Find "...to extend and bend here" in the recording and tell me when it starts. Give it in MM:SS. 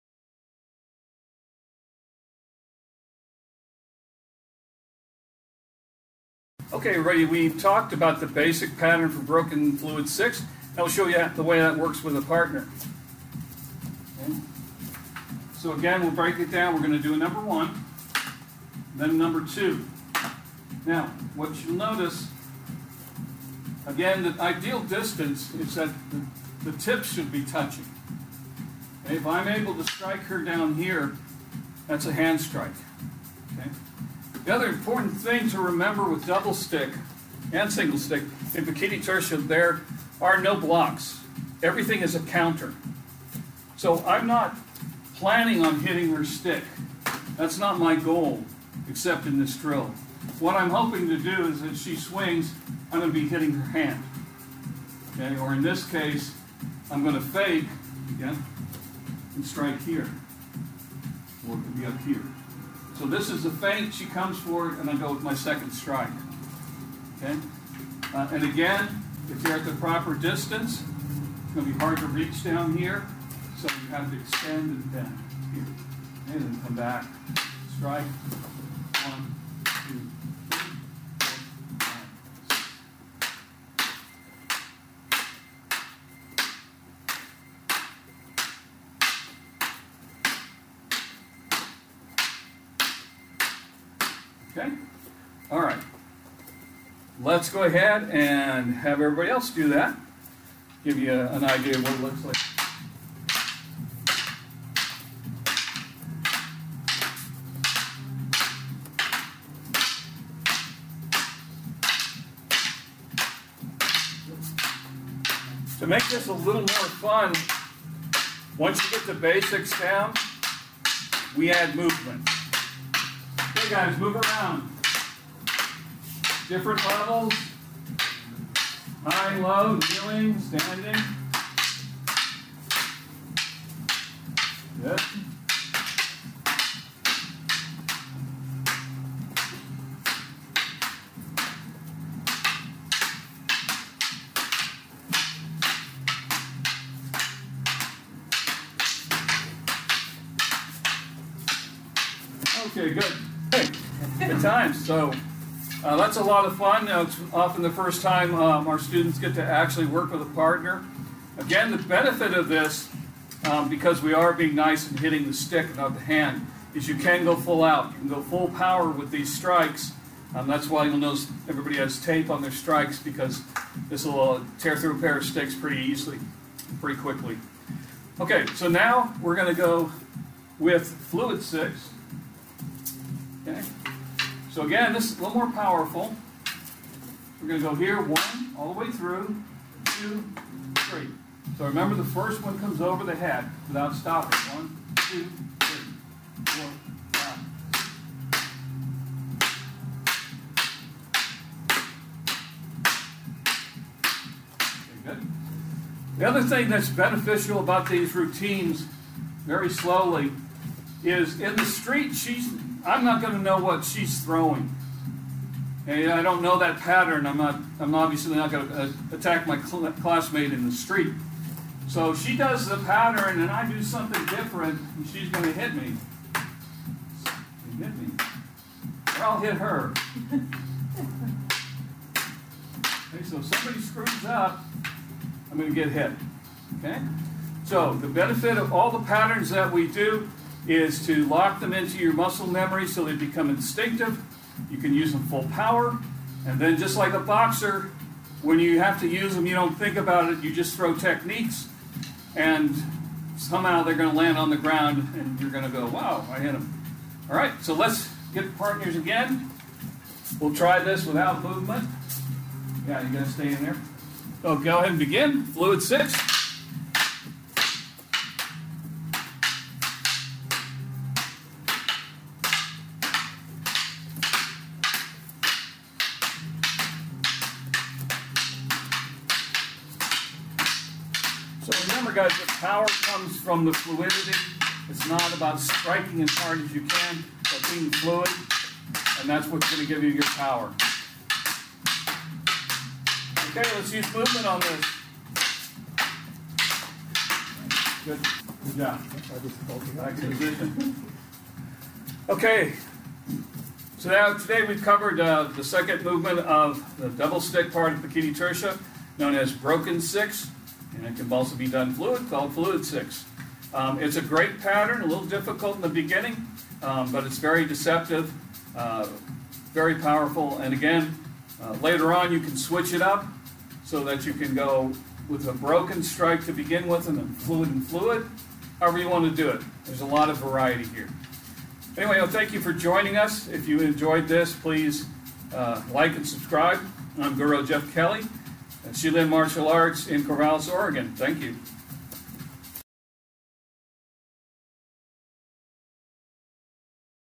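01:14.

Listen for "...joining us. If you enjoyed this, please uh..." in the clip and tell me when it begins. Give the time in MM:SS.
05:32.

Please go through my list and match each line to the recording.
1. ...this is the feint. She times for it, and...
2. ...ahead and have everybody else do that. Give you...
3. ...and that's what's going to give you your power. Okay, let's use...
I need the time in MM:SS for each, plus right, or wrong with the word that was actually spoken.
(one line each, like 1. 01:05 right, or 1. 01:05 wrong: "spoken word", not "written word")
1. 01:03 wrong: "comes", not "times"
2. 01:37 right
3. 04:49 right.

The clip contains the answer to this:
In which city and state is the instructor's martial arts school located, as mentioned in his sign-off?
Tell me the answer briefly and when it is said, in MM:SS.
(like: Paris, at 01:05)
Corvallis, Oregon, at 05:40.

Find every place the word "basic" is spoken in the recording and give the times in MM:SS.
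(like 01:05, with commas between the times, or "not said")
00:08, 01:59.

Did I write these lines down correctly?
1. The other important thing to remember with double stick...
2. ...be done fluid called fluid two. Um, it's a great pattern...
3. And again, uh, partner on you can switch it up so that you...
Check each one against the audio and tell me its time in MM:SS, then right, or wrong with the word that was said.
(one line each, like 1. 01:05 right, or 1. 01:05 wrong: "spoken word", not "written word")
1. 00:34 right
2. 05:11 wrong: "six", not "two"
3. 05:20 wrong: "later", not "partner".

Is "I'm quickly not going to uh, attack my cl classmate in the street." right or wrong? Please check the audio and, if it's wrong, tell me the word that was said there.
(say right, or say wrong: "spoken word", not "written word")
wrong: "obviously", not "quickly".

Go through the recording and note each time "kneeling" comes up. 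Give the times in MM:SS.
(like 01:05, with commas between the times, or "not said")
02:10.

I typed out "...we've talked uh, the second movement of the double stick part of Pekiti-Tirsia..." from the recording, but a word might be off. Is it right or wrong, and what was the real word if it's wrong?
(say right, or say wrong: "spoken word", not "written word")
wrong: "covered", not "talked".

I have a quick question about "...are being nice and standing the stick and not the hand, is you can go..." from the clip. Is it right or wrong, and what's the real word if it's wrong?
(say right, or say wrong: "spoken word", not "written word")
wrong: "hitting", not "standing".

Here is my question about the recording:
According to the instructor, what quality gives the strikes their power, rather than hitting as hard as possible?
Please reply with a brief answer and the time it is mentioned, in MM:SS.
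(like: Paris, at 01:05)
Fluidity, at 04:43.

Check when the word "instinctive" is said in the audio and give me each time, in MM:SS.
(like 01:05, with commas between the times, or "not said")
04:03.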